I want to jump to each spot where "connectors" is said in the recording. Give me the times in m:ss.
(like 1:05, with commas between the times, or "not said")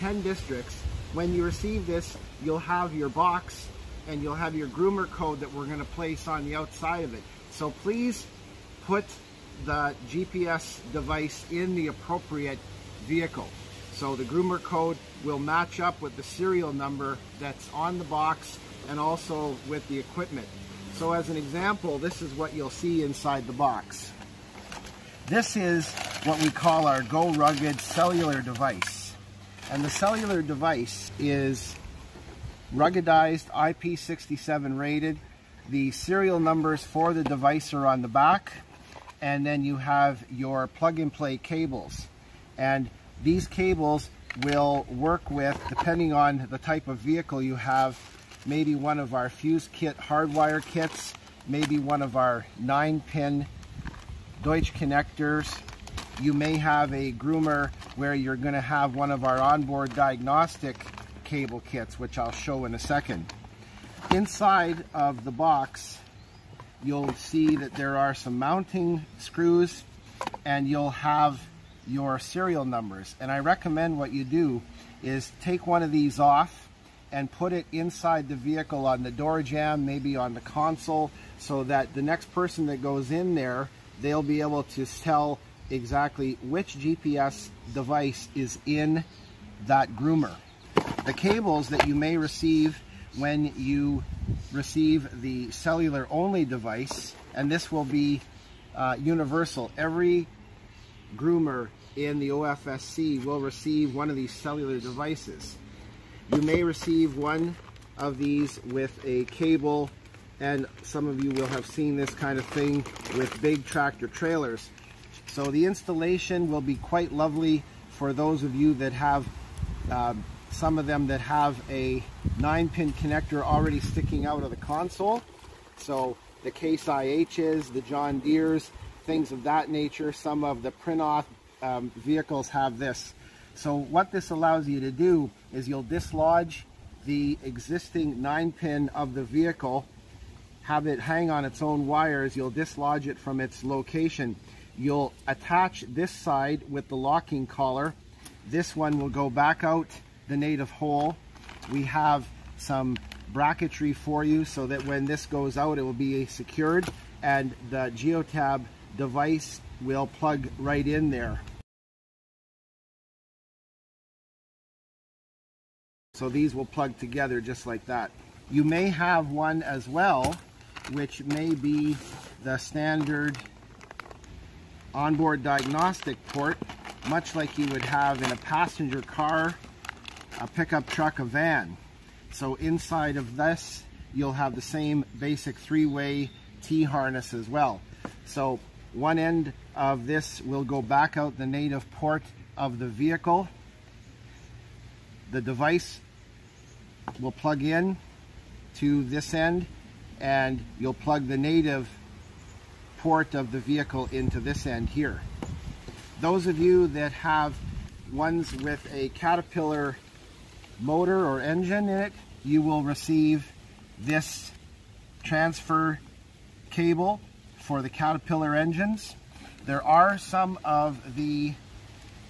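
0:54, 2:02.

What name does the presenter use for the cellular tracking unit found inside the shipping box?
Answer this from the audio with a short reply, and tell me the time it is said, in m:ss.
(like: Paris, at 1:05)
Go Rugged, at 0:27.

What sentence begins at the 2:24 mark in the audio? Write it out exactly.
You'll attach this side with the locking collar.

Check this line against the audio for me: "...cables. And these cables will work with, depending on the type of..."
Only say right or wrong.
right.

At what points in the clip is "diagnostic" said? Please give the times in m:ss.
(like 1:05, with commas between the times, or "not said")
0:59, 2:55.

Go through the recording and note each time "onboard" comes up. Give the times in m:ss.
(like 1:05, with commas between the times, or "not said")
0:59, 2:54.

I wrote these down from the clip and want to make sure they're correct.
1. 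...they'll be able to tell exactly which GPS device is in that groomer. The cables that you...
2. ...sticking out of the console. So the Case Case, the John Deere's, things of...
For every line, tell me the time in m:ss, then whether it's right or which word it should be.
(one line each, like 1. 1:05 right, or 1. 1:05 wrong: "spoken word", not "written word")
1. 1:24 right
2. 2:03 wrong: "IHs", not "Case".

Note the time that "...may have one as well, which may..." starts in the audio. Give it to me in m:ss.
2:48.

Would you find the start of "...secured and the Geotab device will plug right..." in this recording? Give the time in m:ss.
2:36.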